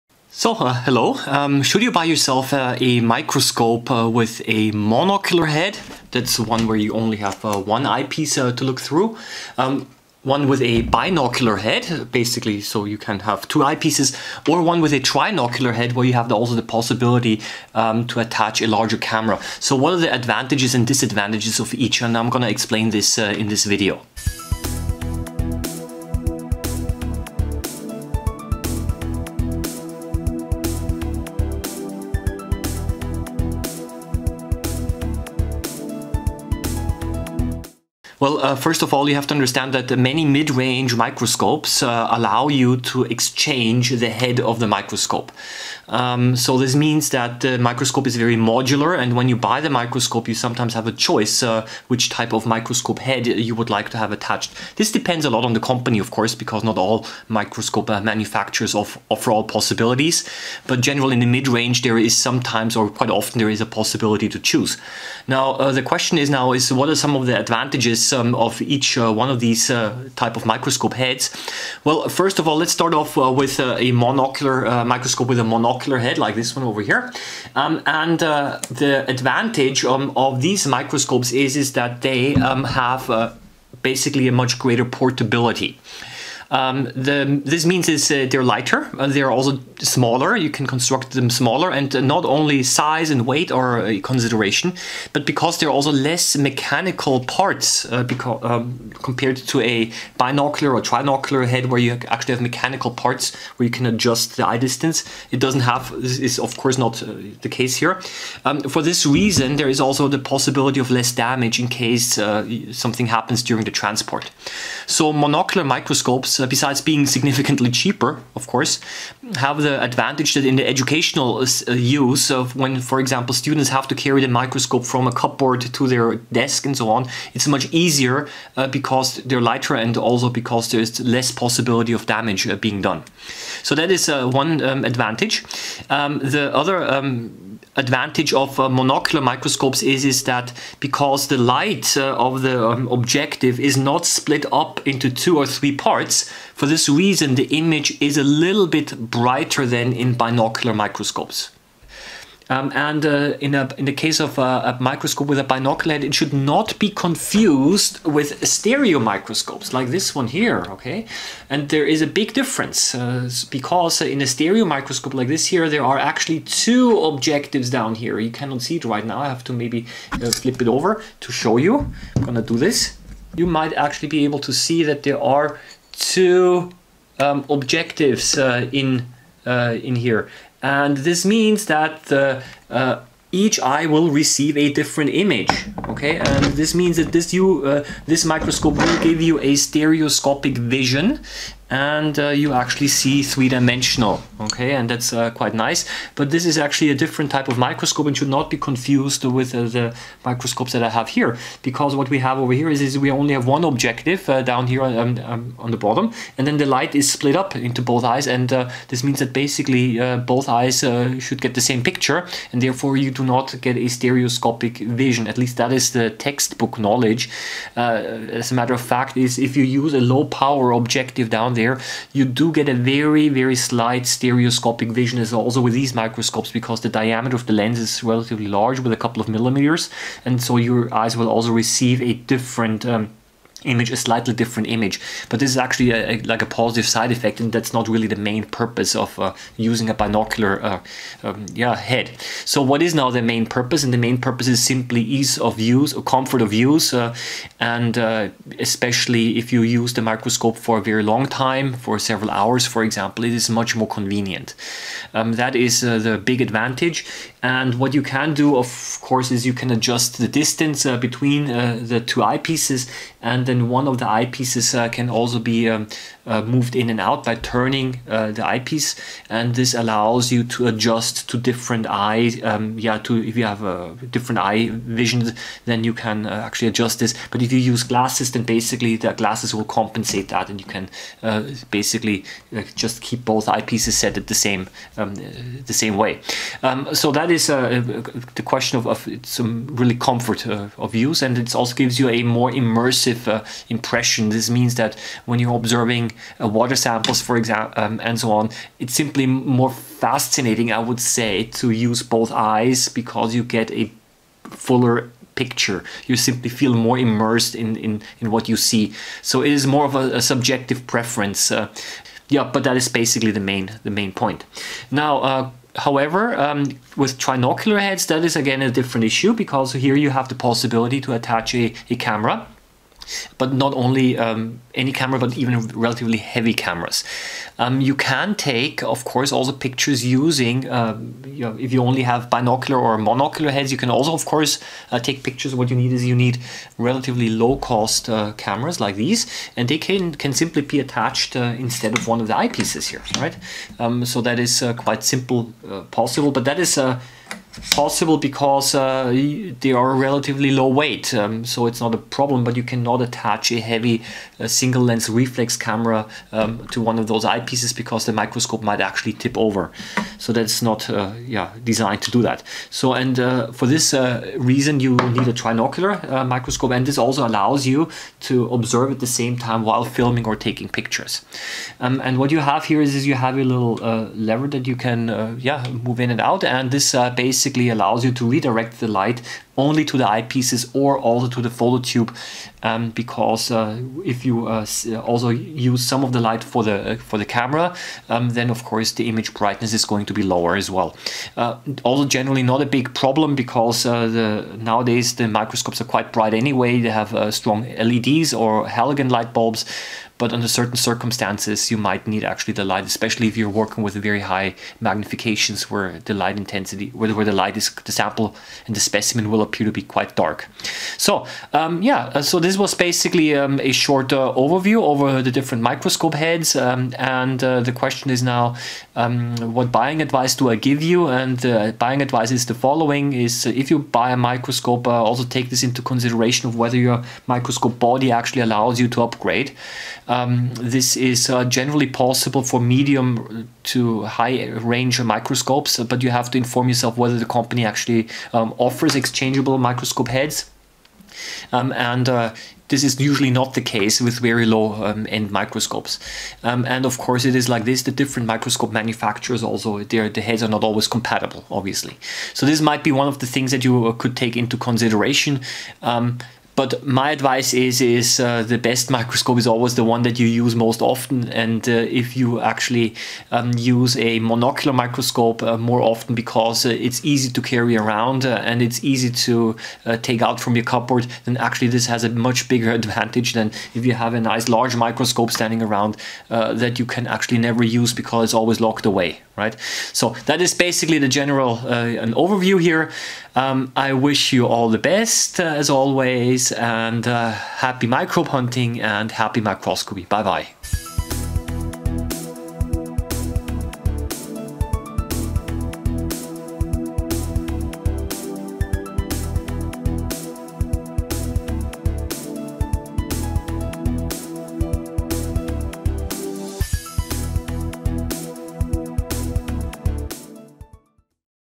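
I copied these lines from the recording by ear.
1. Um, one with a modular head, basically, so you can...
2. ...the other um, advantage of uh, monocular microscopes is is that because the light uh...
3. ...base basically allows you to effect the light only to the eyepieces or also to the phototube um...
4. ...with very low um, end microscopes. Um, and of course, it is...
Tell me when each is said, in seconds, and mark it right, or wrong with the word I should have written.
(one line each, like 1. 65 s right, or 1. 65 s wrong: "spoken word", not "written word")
1. 9 s wrong: "binocular", not "modular"
2. 136 s right
3. 377 s wrong: "redirect", not "effect"
4. 444 s right.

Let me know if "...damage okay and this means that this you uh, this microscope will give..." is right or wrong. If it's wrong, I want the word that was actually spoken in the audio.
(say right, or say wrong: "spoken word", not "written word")
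wrong: "image", not "damage".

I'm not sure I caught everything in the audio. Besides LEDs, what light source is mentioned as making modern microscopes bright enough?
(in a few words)
halogen light bulbs.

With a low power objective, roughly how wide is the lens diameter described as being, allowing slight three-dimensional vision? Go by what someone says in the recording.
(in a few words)
a couple of millimeters.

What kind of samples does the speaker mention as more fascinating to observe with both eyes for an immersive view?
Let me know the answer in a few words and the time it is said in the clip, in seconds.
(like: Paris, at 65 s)
water samples, at 296 s.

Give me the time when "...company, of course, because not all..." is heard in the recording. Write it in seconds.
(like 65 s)
55 s.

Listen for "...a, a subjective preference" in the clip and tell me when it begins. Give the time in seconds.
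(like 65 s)
309 s.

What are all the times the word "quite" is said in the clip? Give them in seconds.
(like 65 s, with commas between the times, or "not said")
62 s, 195 s, 344 s, 395 s, 409 s.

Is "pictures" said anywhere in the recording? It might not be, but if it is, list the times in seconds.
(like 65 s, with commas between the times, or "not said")
211 s, 305 s, 329 s, 335 s, 370 s.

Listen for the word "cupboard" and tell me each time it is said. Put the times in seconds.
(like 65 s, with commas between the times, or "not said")
125 s, 470 s.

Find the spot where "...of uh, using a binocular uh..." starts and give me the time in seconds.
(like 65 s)
238 s.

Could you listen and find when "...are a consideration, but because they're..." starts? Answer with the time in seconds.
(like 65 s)
93 s.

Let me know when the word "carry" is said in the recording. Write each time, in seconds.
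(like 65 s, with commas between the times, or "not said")
123 s, 467 s.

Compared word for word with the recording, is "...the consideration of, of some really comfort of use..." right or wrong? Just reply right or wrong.
wrong.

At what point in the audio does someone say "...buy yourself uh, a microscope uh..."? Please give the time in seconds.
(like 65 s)
1 s.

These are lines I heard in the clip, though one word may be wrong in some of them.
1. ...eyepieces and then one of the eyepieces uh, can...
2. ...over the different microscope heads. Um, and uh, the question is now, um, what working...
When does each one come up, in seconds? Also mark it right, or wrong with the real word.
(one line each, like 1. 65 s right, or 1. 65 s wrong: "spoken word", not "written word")
1. 262 s right
2. 414 s wrong: "buying", not "working".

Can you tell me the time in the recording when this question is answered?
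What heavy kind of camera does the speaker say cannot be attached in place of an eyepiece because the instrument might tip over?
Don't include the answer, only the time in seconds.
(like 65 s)
354 s.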